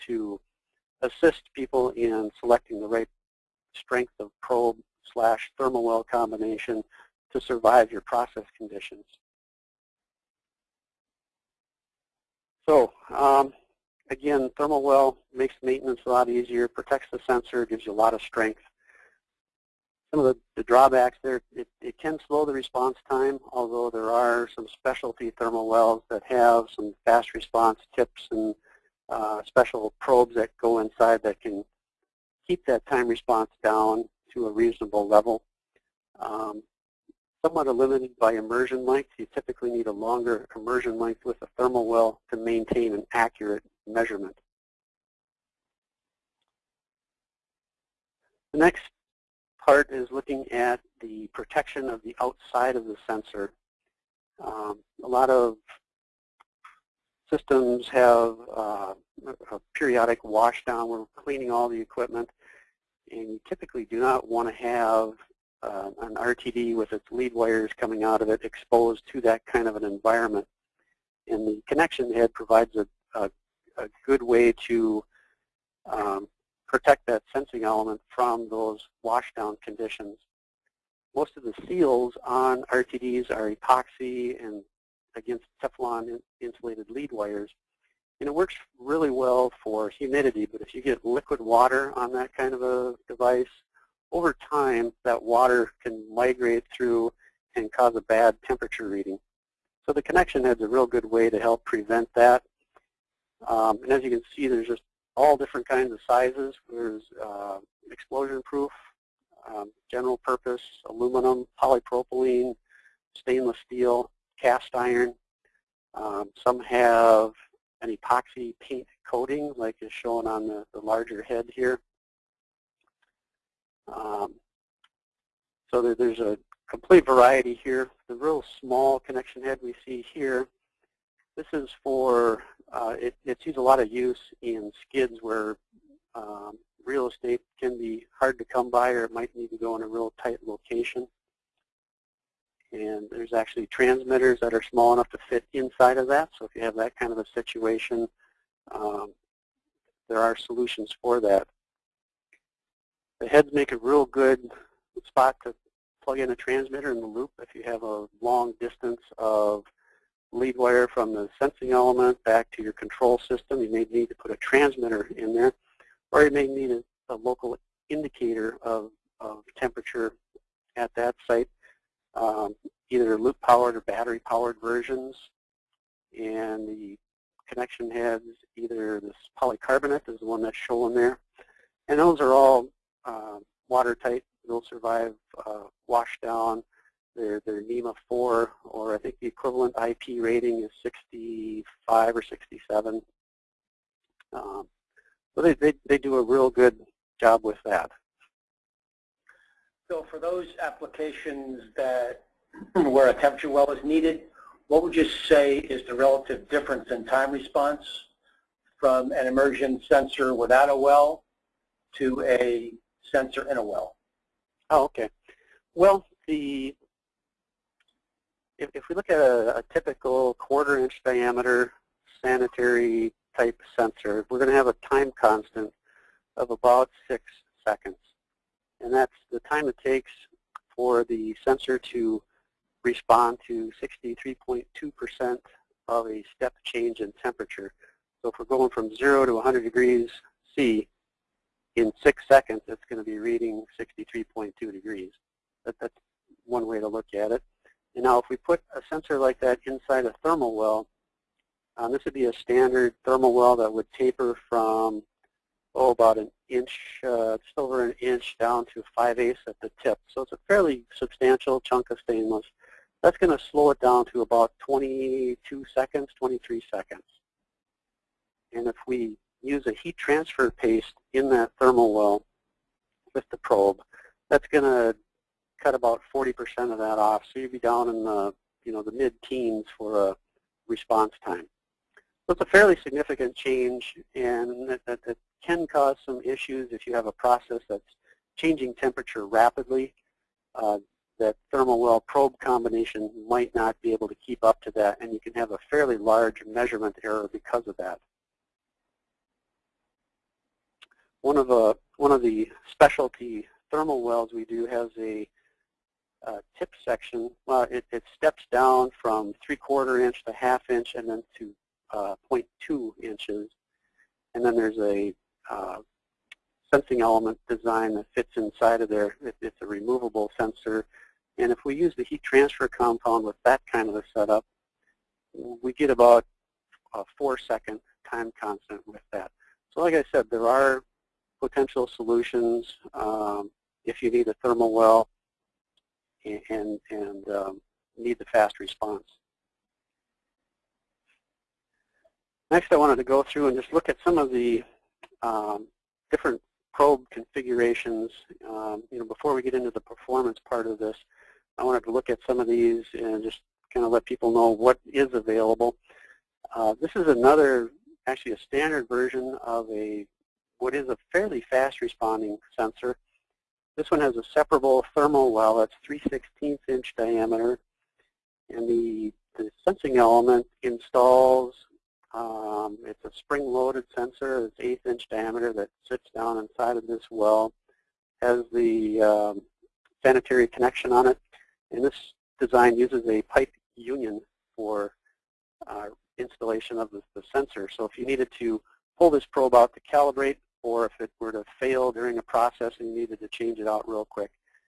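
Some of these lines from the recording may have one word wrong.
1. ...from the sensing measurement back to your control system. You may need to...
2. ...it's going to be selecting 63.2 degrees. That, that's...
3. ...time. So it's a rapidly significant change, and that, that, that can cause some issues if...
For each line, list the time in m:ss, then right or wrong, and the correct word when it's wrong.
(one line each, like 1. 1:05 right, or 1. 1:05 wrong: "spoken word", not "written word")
1. 2:40 wrong: "element", not "measurement"
2. 4:02 wrong: "reading", not "selecting"
3. 4:41 wrong: "fairly", not "rapidly".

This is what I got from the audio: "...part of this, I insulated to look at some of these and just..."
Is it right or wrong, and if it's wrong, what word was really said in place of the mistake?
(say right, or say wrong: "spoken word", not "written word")
wrong: "wanted", not "insulated".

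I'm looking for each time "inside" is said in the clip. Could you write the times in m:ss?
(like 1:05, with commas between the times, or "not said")
0:30, 2:25, 4:09, 5:18, 6:16.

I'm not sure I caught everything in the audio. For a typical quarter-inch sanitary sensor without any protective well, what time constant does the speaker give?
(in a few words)
About 6 seconds.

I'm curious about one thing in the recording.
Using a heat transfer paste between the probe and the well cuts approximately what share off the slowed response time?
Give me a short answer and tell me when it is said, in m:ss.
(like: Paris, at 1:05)
About 40%, at 4:35.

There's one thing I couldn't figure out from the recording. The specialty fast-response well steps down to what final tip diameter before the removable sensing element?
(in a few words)
0.2 inches.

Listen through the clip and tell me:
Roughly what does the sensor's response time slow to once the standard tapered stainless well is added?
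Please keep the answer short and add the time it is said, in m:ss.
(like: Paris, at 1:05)
About 22 seconds, at 4:24.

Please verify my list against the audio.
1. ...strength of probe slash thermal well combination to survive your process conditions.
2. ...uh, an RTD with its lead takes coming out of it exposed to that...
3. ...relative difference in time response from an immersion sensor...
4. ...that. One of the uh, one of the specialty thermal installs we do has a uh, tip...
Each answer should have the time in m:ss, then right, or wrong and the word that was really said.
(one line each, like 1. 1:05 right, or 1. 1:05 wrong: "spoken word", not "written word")
1. 0:03 right
2. 1:05 wrong: "wires", not "takes"
3. 3:25 right
4. 4:57 wrong: "wells", not "installs".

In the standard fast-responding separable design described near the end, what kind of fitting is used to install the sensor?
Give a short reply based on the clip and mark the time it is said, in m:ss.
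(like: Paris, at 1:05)
A pipe union, at 6:23.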